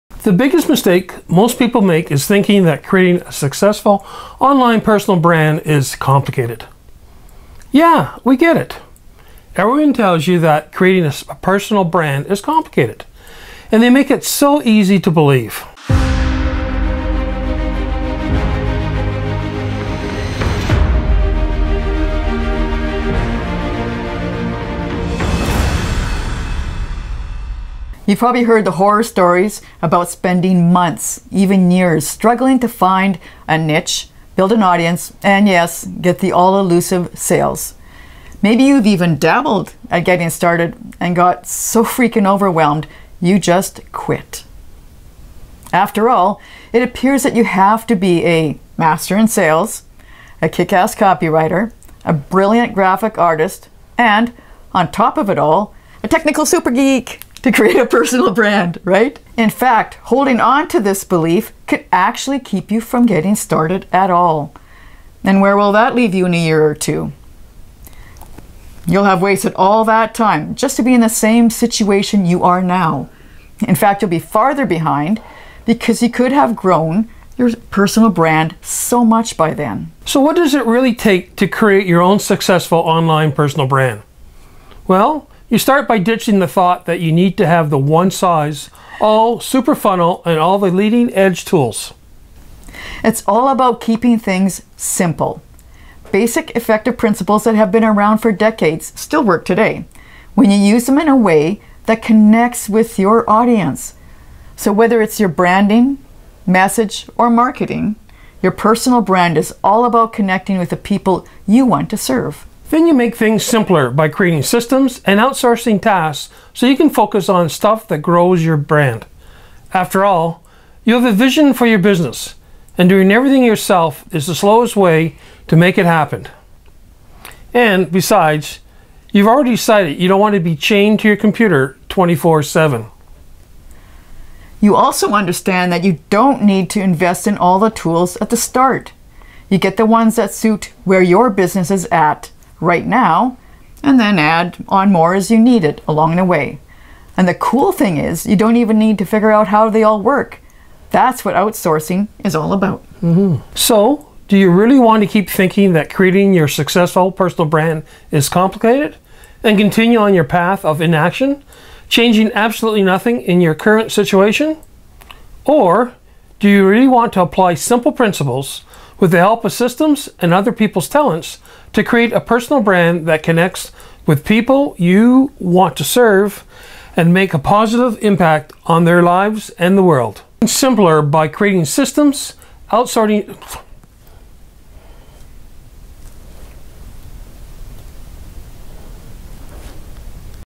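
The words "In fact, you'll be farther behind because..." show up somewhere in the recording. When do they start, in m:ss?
1:13.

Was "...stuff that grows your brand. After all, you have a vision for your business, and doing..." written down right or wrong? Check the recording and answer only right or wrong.
right.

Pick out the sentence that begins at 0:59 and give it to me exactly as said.
In fact, holding on to this belief could actually keep you from getting started at all.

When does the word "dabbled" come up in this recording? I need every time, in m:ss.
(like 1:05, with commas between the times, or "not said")
0:39.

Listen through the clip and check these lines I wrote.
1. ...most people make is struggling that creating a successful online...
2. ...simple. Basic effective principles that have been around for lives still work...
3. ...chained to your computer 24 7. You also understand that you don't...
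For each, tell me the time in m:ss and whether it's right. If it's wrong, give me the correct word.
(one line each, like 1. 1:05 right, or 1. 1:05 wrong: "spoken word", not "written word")
1. 0:01 wrong: "thinking", not "struggling"
2. 1:34 wrong: "decades", not "lives"
3. 2:10 right.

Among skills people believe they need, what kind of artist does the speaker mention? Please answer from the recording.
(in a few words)
brilliant graphic artist.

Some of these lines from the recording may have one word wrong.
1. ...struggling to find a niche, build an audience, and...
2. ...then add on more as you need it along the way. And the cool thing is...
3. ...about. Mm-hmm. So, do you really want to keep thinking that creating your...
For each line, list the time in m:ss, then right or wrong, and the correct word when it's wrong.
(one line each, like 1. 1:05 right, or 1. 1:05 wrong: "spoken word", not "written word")
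1. 0:32 right
2. 2:23 right
3. 2:32 right.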